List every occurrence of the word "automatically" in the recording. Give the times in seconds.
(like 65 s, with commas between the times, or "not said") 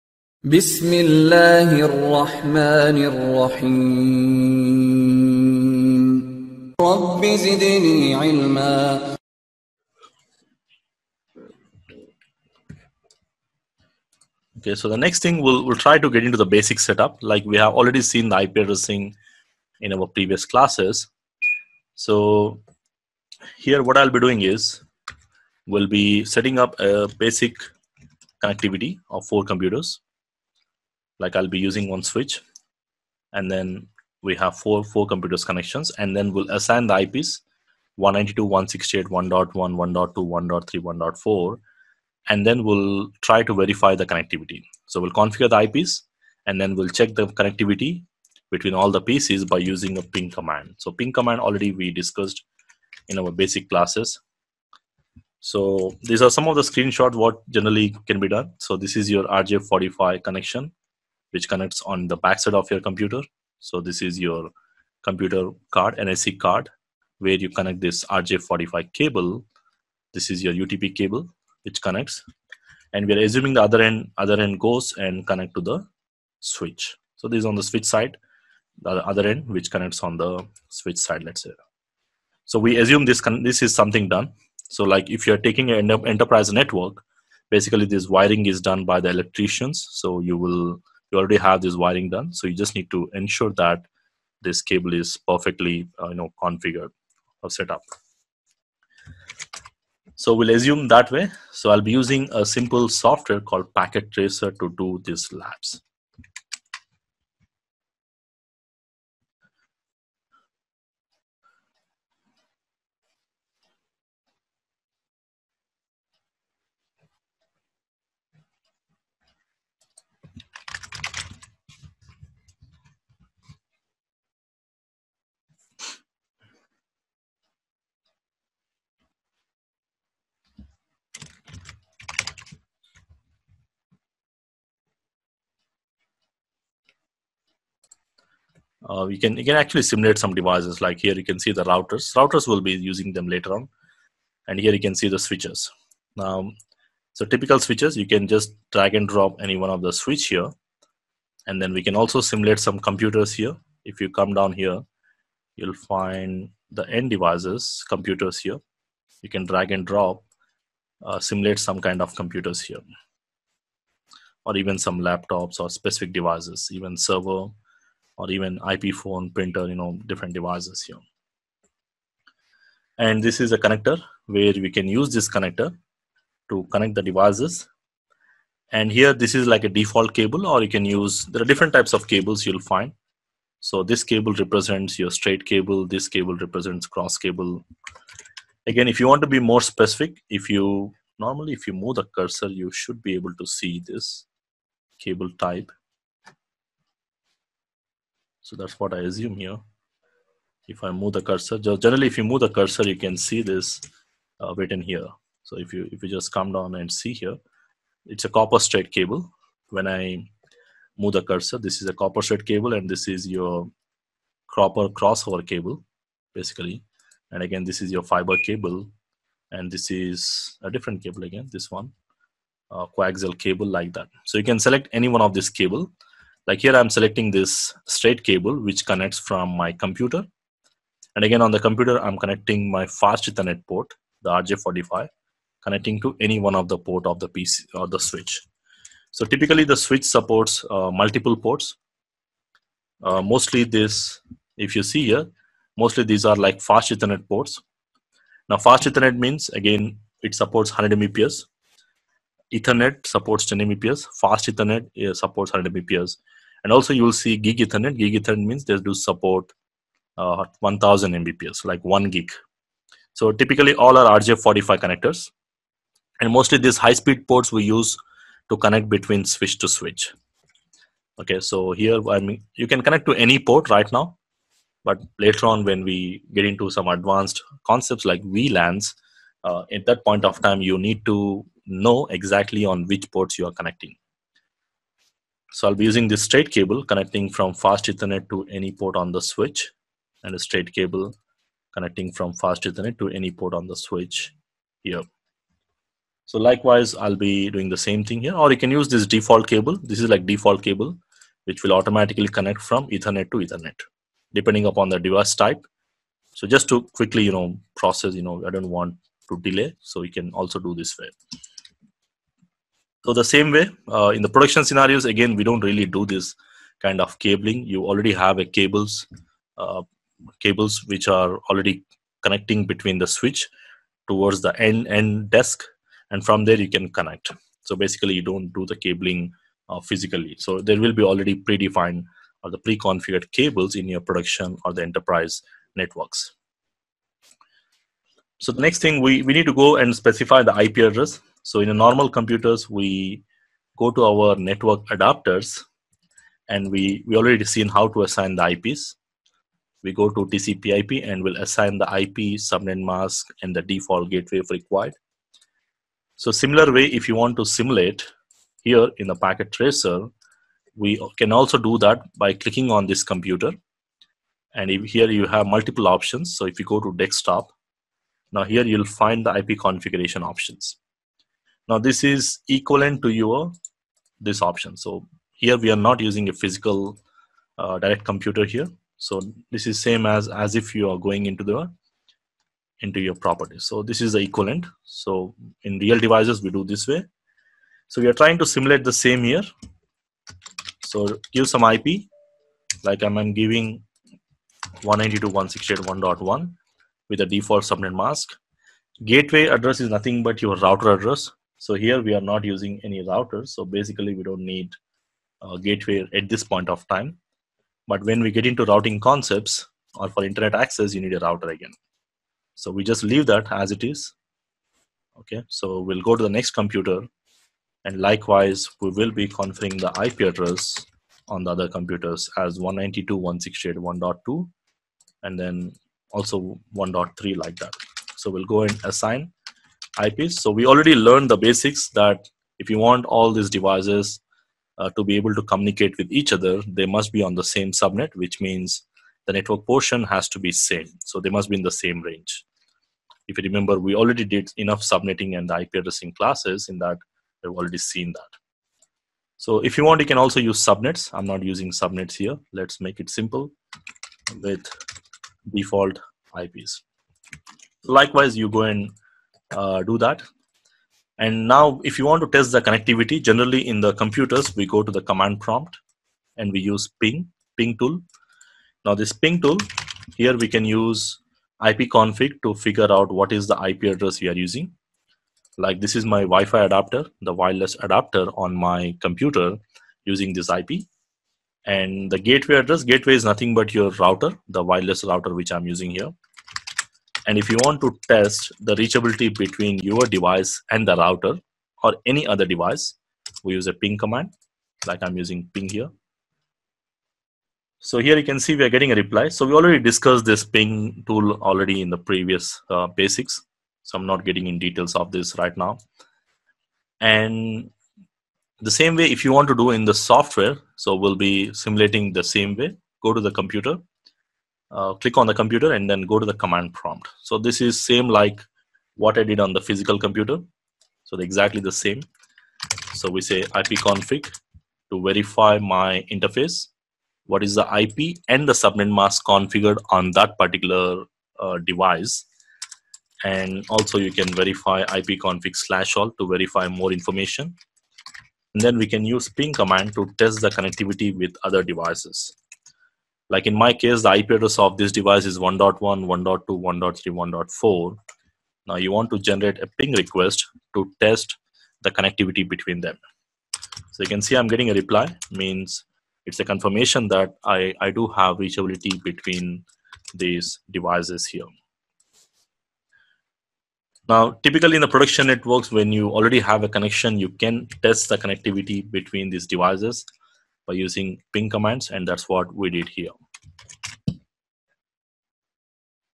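301 s.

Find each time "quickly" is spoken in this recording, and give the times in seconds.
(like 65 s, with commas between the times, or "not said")
306 s.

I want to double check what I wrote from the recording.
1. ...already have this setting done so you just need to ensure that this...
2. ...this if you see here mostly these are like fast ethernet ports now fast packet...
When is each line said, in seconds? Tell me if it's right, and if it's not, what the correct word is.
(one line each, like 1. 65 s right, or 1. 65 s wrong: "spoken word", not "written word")
1. 91 s wrong: "wiring", not "setting"
2. 243 s wrong: "ethernet", not "packet".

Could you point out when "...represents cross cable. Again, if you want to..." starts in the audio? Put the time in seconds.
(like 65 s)
186 s.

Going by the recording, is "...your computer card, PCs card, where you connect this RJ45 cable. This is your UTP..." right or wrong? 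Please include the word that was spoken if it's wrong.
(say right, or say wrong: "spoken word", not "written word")
wrong: "NIC", not "PCs".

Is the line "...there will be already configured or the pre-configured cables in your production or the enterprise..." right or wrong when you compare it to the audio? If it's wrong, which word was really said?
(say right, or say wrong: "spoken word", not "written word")
wrong: "predefined", not "configured".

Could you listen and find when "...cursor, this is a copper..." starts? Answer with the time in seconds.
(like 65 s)
211 s.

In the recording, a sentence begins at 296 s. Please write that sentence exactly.
So likewise, I'll be doing the same thing here, or you can use this default cable.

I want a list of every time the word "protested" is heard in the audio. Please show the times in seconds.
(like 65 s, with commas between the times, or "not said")
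not said.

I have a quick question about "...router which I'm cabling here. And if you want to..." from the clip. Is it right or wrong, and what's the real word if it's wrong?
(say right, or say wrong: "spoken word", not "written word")
wrong: "using", not "cabling".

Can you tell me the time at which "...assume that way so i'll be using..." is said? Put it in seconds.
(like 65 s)
100 s.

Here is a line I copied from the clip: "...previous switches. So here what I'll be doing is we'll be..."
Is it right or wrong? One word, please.
wrong.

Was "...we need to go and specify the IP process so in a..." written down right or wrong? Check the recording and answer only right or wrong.
wrong.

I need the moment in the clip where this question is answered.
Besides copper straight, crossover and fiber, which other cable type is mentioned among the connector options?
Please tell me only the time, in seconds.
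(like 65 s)
222 s.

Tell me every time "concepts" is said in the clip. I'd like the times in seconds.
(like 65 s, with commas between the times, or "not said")
277 s, 408 s.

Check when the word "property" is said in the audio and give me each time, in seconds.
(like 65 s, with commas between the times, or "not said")
383 s.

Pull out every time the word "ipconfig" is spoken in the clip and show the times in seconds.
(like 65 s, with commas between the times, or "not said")
471 s, 523 s, 534 s.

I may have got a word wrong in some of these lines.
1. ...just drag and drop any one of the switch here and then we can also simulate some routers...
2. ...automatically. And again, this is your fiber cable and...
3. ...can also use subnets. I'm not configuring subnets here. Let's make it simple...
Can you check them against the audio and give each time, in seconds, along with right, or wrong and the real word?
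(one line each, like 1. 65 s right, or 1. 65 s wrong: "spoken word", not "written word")
1. 148 s wrong: "computers", not "routers"
2. 216 s wrong: "basically", not "automatically"
3. 450 s wrong: "using", not "configuring".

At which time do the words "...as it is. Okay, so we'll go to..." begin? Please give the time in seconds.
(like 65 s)
413 s.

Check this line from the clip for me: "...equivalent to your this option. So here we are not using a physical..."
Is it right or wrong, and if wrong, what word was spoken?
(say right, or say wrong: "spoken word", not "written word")
right.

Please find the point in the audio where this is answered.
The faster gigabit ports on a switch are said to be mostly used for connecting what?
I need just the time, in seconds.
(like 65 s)
269 s.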